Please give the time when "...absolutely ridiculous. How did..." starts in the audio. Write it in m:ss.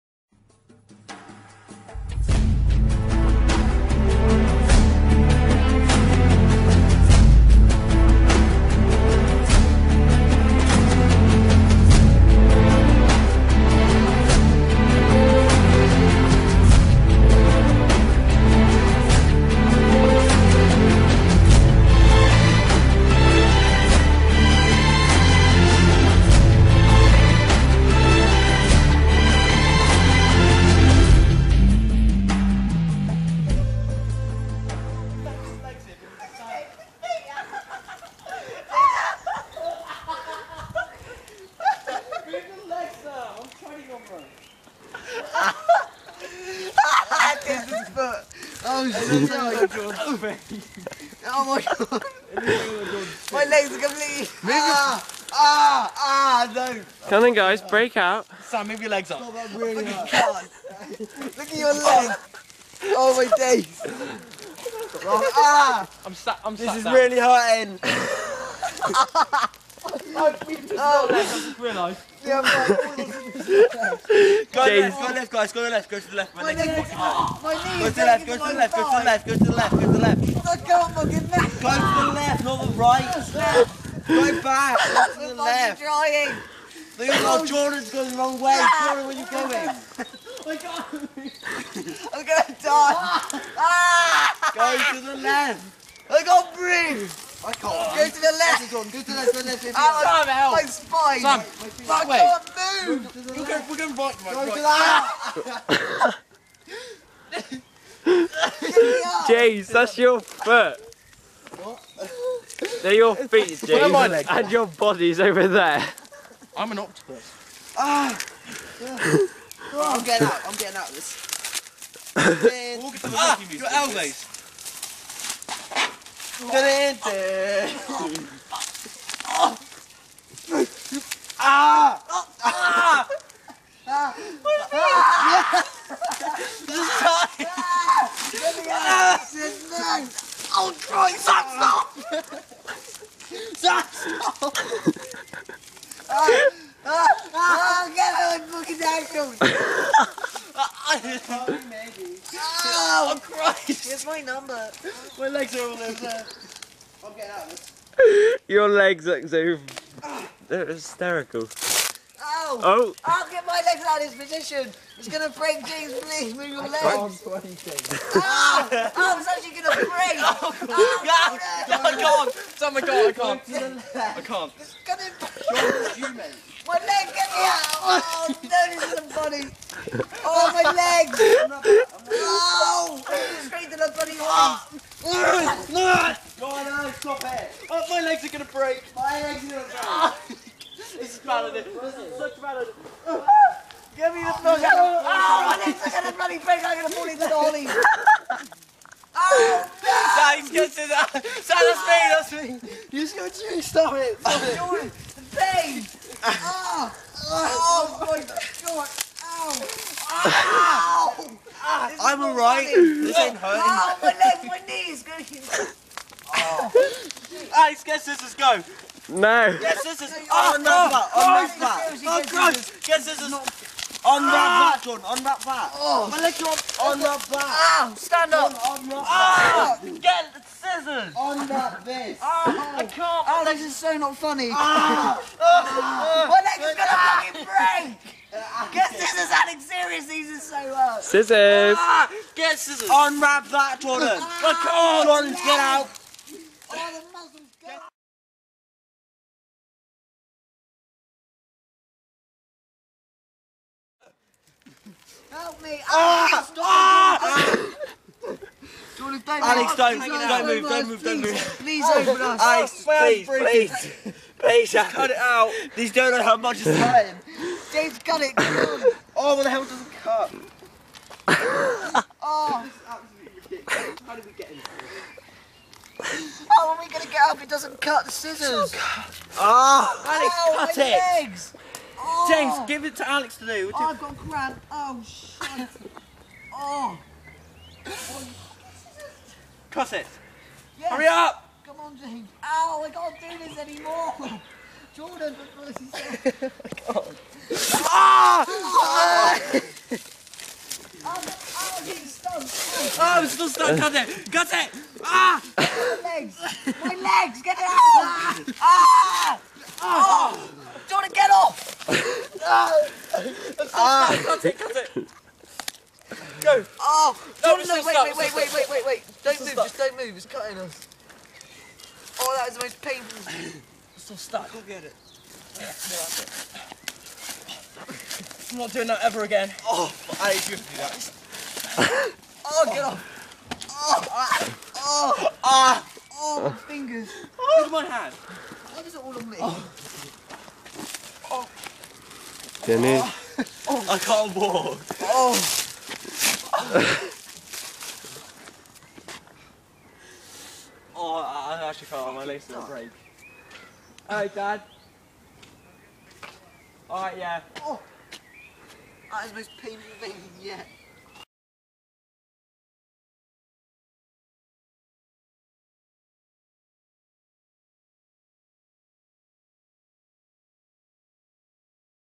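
4:33.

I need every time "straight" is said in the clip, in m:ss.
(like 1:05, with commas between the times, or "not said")
3:03.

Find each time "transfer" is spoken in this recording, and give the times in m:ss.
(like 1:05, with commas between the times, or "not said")
not said.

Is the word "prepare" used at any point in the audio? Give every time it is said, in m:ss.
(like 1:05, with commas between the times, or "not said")
not said.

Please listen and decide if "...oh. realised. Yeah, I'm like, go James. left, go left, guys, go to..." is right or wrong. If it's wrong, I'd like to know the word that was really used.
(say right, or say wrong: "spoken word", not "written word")
right.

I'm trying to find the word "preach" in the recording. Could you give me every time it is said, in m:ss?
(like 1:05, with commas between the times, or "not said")
not said.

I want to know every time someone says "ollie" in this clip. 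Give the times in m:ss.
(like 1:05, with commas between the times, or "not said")
3:17.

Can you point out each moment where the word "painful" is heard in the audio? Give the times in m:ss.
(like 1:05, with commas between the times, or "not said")
5:22, 5:59.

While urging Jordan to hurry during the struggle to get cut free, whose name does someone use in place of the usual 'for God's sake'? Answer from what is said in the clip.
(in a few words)
Felicity.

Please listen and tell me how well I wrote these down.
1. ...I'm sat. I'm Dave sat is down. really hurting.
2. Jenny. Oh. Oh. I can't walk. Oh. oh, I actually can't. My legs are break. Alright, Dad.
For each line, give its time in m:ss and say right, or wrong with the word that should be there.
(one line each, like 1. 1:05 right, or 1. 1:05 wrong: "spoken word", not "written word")
1. 1:06 wrong: "This", not "Dave"
2. 5:42 right.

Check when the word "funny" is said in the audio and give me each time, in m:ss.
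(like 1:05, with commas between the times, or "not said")
2:59, 3:54.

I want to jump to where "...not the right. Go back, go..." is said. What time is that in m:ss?
1:22.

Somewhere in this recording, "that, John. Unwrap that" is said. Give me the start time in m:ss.
3:44.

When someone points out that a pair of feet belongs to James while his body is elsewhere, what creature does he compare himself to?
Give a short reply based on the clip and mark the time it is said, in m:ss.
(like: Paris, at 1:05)
octopus, at 1:56.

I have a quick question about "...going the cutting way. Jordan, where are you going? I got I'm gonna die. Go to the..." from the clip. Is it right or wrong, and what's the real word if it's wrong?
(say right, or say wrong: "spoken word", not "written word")
wrong: "wrong", not "cutting".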